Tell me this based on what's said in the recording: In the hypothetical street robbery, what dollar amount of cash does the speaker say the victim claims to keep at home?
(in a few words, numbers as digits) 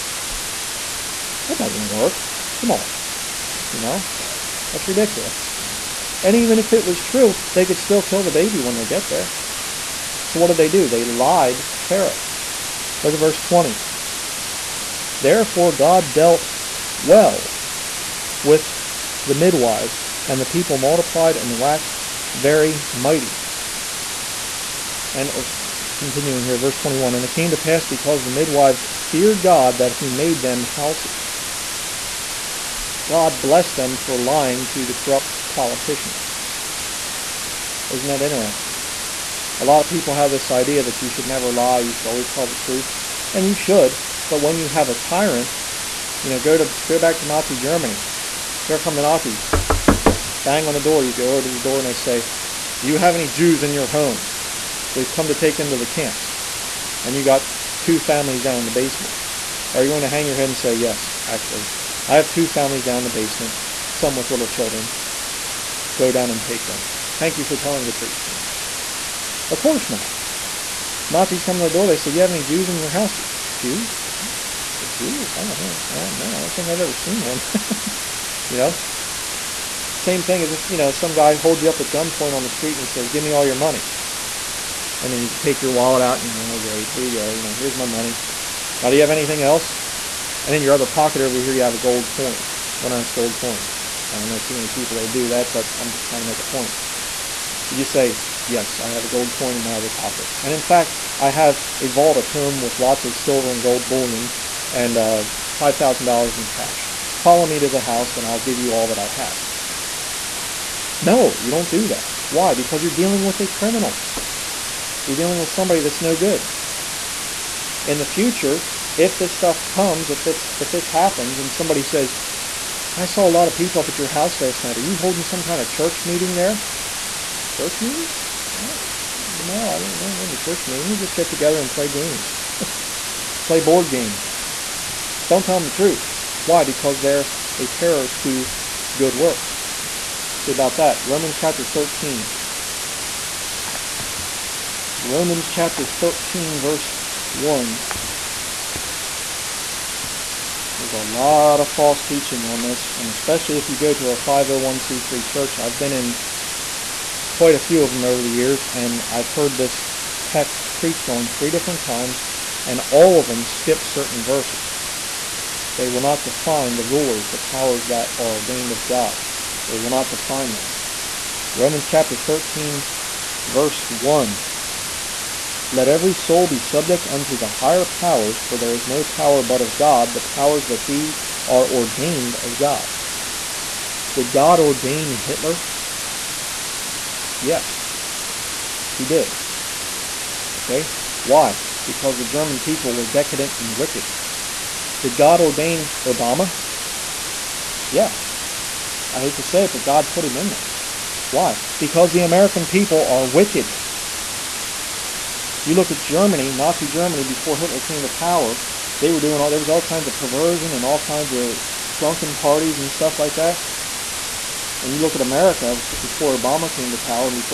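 $5,000.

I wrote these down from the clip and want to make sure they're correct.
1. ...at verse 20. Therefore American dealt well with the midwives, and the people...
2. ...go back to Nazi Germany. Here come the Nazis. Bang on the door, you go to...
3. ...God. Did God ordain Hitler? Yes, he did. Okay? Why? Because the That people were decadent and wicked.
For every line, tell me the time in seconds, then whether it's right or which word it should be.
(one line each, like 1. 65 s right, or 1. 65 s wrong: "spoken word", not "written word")
1. 13 s wrong: "God", not "American"
2. 46 s right
3. 182 s wrong: "German", not "That".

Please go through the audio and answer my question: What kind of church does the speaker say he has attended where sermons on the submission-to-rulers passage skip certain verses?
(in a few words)
501c3 church.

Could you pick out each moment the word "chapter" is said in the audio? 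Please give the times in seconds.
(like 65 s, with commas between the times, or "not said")
141 s, 145 s, 171 s.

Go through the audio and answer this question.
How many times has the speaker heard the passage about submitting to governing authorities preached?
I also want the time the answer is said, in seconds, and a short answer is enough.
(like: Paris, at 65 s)
3, at 161 s.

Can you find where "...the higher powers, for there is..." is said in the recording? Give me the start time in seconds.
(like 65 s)
177 s.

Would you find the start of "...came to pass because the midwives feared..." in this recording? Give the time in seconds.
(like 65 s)
27 s.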